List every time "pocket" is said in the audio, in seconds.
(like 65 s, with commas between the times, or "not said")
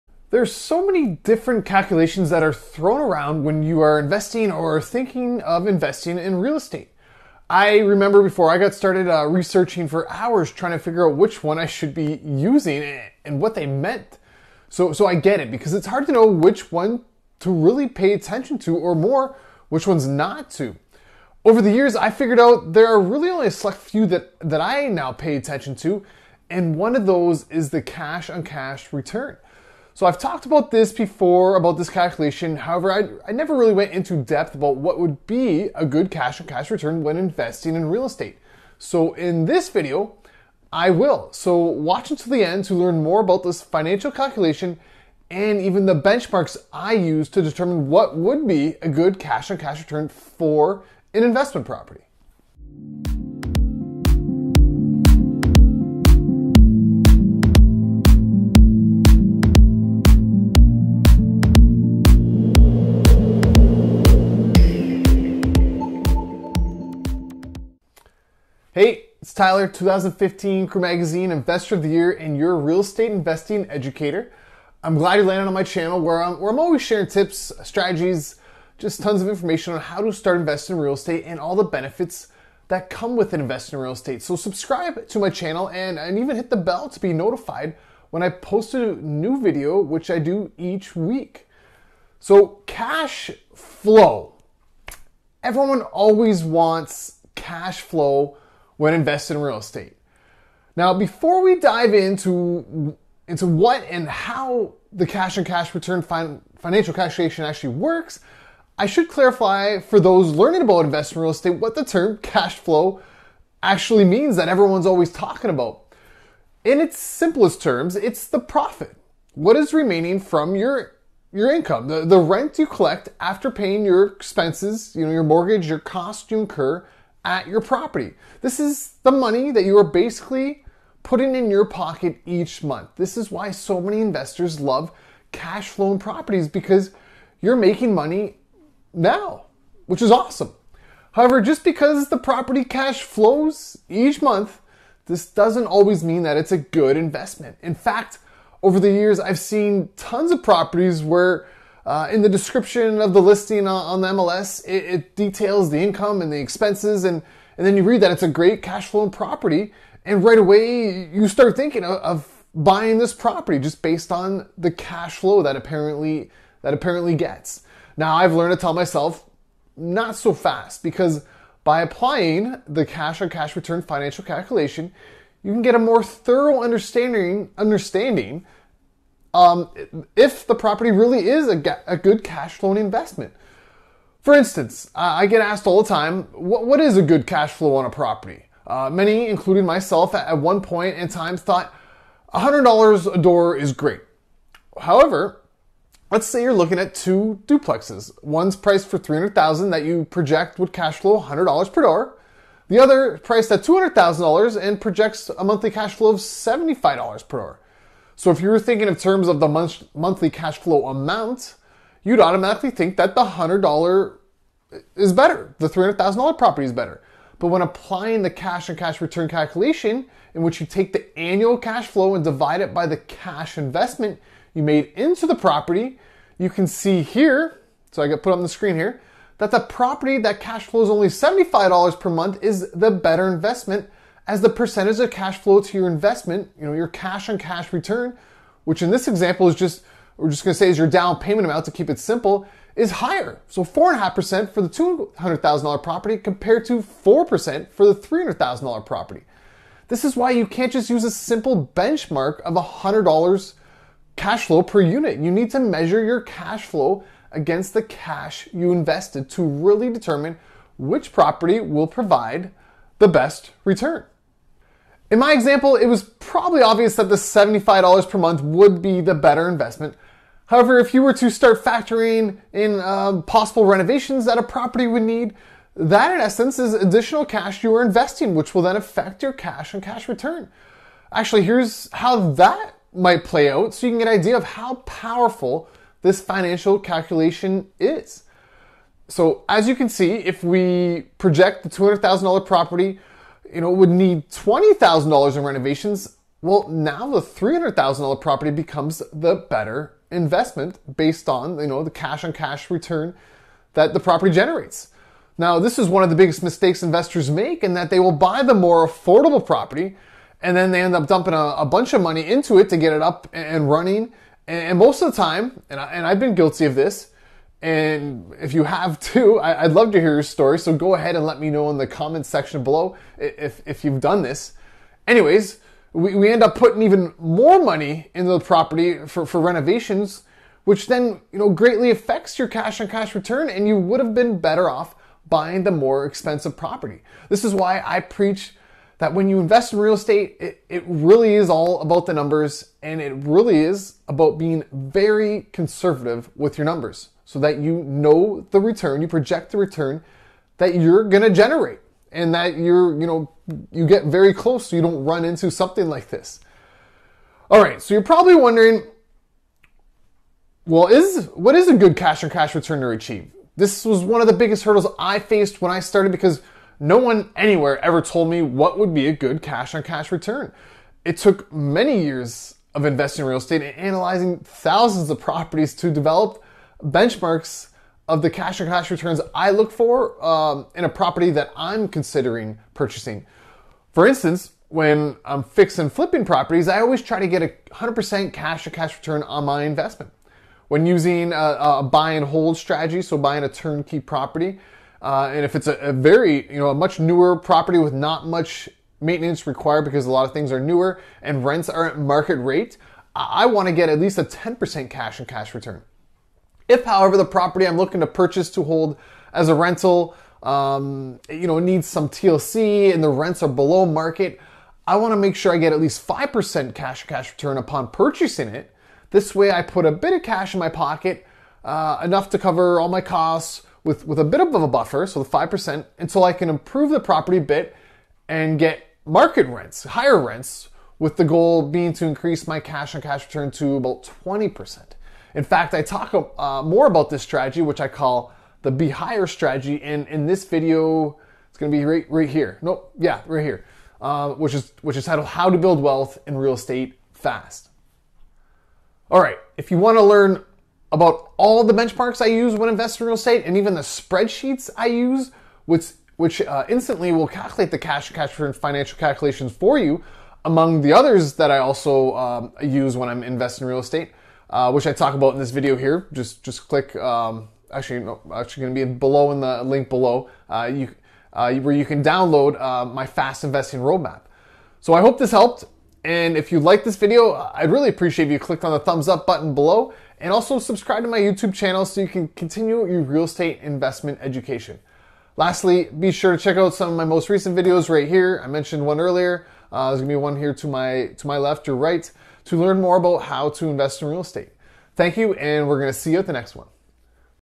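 131 s, 420 s.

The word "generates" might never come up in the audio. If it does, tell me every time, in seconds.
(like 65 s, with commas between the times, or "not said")
304 s, 351 s.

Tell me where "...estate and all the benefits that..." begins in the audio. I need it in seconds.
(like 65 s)
80 s.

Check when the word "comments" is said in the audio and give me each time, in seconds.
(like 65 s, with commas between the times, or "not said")
321 s.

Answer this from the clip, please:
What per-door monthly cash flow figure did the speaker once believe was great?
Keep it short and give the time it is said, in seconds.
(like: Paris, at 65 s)
$100 a door, at 192 s.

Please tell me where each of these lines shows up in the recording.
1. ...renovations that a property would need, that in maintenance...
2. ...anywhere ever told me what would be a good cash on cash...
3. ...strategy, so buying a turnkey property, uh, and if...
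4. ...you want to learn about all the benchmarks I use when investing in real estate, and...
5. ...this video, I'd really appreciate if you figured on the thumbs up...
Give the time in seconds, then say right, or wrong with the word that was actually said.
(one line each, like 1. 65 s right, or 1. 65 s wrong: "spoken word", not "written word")
1. 273 s wrong: "essence", not "maintenance"
2. 367 s right
3. 392 s right
4. 449 s right
5. 476 s wrong: "clicked", not "figured".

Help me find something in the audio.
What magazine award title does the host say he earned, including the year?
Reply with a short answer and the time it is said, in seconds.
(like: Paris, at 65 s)
2015 Crew Magazine Investor of the Year, at 69 s.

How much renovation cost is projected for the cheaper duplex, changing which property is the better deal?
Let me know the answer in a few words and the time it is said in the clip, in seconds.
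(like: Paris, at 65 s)
$20,000, at 294 s.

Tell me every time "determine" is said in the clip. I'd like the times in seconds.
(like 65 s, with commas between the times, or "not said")
47 s, 259 s.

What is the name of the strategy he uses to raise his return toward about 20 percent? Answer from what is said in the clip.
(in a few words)
Be Higher strategy.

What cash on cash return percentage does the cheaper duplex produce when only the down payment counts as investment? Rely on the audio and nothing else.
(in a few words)
4.5%.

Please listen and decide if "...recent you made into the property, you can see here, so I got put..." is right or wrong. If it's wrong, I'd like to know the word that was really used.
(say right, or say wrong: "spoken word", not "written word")
wrong: "investment", not "recent".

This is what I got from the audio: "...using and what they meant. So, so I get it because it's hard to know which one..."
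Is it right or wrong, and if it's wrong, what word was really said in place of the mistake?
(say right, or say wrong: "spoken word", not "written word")
right.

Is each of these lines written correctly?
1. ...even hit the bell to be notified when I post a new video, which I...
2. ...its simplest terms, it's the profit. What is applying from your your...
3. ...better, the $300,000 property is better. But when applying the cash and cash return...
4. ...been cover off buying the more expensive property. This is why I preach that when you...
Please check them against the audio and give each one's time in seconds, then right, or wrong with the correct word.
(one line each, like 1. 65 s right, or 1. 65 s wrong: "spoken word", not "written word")
1. 86 s right
2. 116 s wrong: "remaining", not "applying"
3. 215 s right
4. 334 s wrong: "better", not "cover".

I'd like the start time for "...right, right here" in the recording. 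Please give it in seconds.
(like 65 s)
441 s.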